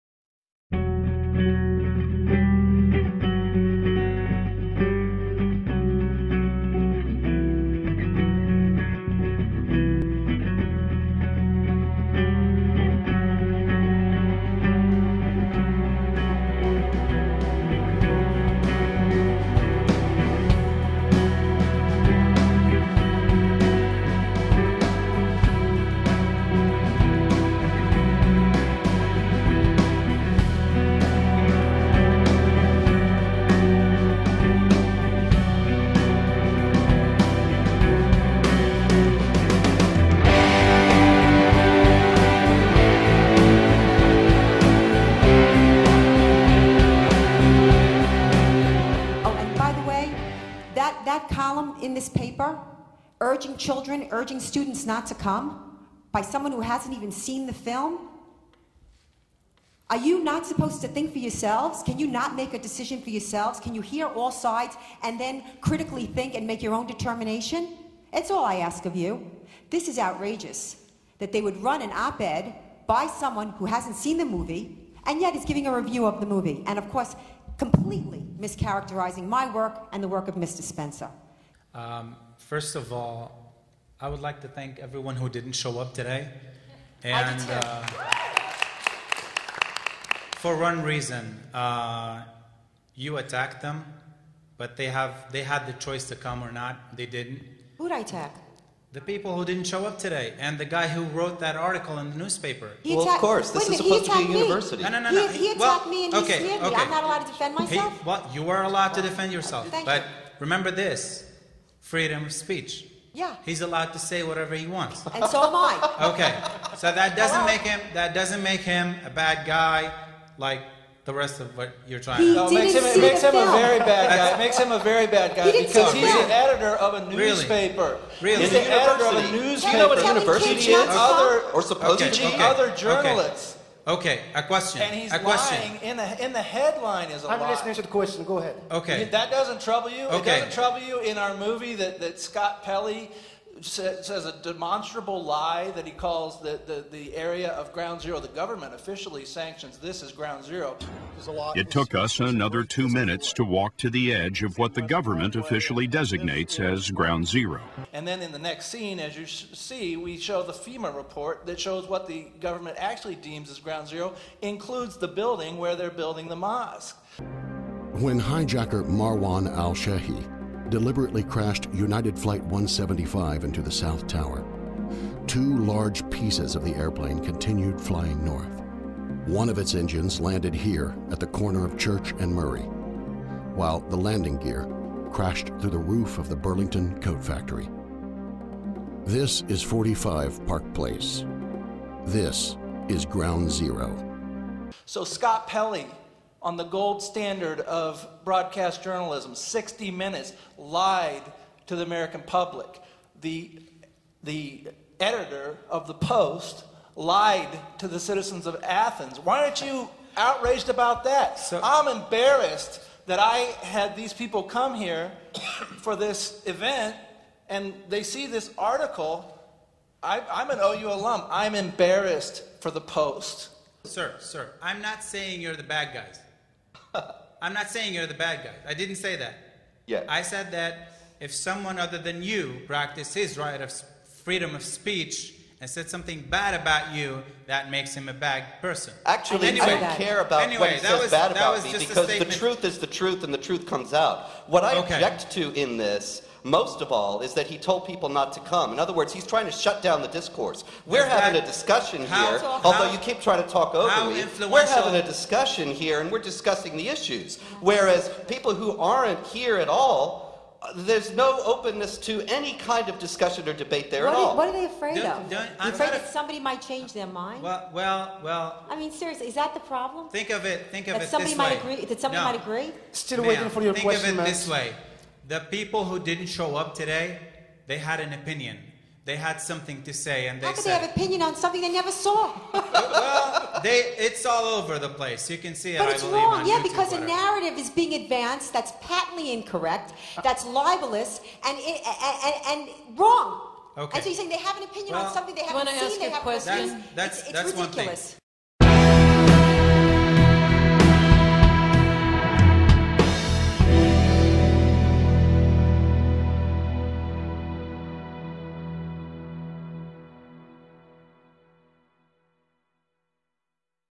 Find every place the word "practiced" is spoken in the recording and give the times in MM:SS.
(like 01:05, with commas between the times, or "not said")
03:52.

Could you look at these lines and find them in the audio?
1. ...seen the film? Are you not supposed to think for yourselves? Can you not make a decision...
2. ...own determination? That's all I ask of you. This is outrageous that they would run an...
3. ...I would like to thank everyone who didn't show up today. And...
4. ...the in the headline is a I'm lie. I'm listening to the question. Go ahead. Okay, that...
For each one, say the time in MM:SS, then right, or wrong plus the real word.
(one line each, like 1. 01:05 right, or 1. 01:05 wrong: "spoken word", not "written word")
1. 00:57 right
2. 01:06 right
3. 01:23 right
4. 02:15 right.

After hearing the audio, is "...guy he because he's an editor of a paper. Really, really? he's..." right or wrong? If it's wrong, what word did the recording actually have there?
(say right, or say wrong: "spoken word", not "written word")
wrong: "newspaper", not "paper".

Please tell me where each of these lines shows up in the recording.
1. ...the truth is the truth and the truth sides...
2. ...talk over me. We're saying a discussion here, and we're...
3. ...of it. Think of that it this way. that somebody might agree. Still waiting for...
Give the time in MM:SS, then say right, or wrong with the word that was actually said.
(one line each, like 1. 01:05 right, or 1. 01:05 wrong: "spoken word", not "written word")
1. 04:02 wrong: "comes", not "sides"
2. 04:13 wrong: "having", not "saying"
3. 04:30 right.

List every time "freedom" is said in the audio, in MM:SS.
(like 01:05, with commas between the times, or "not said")
01:51, 03:54.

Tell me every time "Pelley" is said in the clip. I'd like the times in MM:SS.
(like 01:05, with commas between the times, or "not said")
02:22, 03:15.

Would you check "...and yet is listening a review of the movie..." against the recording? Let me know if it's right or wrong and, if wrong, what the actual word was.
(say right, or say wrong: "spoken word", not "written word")
wrong: "giving", not "listening".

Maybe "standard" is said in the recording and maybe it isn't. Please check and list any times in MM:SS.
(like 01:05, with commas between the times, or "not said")
03:17.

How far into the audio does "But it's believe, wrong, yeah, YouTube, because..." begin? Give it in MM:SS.
04:45.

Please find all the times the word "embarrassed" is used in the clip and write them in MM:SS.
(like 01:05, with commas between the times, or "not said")
03:31, 03:41.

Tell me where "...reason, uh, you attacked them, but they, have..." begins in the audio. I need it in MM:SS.
01:30.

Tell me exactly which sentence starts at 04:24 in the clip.
what are they afraid don't, of?